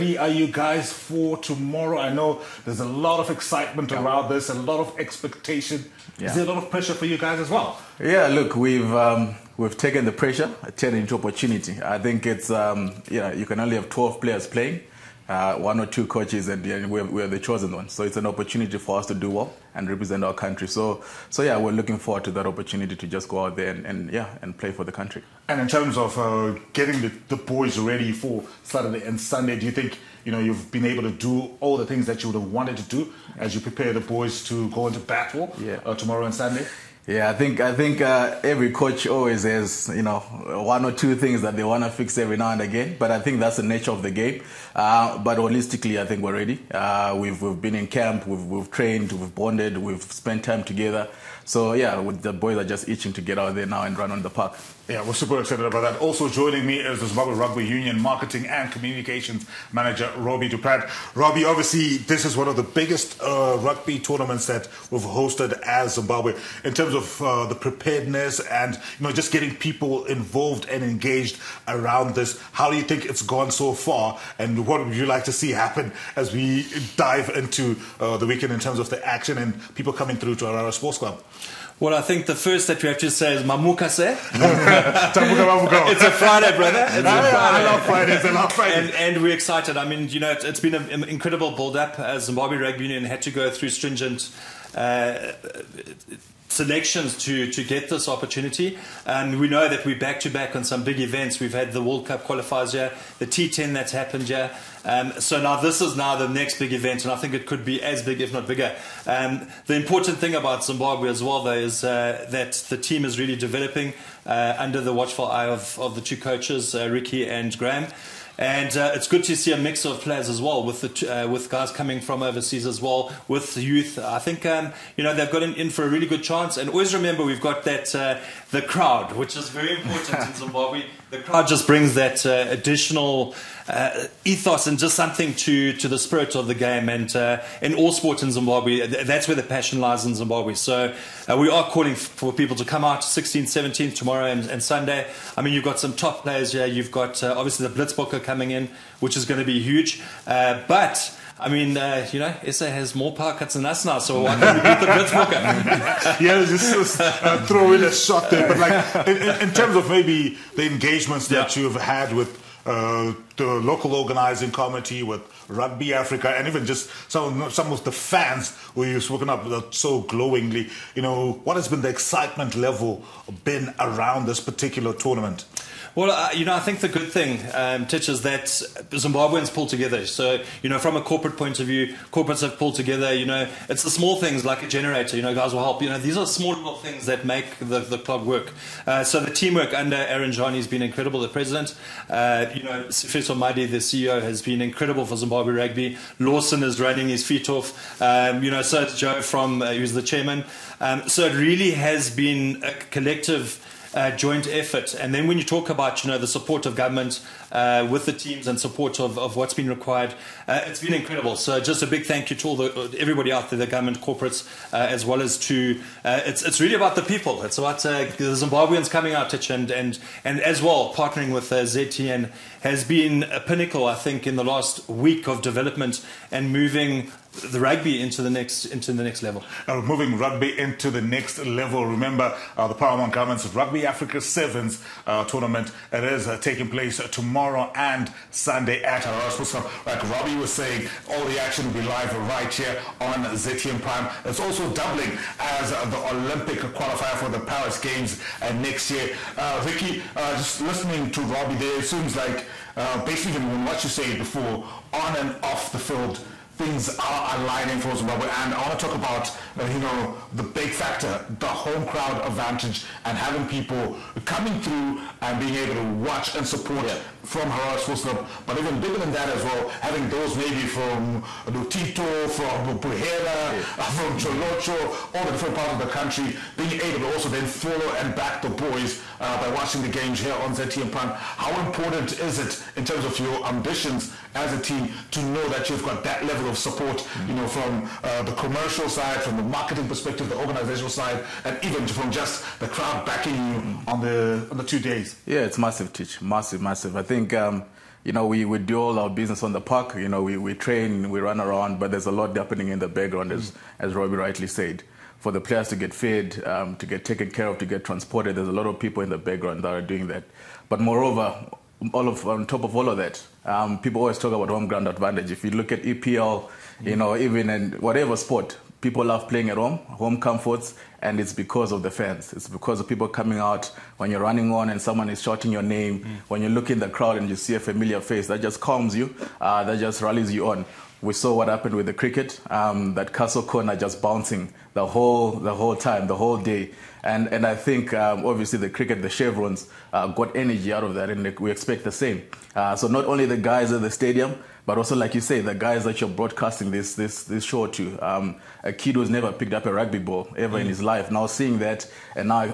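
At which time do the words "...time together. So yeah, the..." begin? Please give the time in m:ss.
0:50.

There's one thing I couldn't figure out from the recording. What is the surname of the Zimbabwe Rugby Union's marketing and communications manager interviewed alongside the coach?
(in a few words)
Du Rand.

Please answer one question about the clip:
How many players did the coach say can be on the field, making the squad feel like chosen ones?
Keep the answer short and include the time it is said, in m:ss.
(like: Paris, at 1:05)
12, at 0:13.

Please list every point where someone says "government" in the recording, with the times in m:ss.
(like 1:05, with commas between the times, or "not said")
3:26, 3:33.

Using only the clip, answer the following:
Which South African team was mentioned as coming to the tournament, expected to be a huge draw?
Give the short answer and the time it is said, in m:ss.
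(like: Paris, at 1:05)
Blitzbokke, at 2:27.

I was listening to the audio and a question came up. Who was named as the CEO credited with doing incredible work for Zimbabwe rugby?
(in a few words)
Sifiso Madi.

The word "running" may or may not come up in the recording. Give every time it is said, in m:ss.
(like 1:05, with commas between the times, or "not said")
3:16, 5:24.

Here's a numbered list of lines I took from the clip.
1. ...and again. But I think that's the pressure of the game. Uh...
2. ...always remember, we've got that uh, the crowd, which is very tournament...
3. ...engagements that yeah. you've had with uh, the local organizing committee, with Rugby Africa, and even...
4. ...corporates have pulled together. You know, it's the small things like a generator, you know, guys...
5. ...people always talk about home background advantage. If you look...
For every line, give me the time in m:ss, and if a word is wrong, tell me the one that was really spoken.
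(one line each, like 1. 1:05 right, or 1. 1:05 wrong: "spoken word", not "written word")
1. 0:42 wrong: "nature", not "pressure"
2. 2:06 wrong: "important", not "tournament"
3. 2:40 right
4. 3:02 right
5. 5:13 wrong: "ground", not "background".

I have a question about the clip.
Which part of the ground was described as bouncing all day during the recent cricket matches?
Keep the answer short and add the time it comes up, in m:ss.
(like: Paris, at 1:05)
castle corner, at 5:33.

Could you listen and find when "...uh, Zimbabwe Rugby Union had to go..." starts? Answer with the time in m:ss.
1:31.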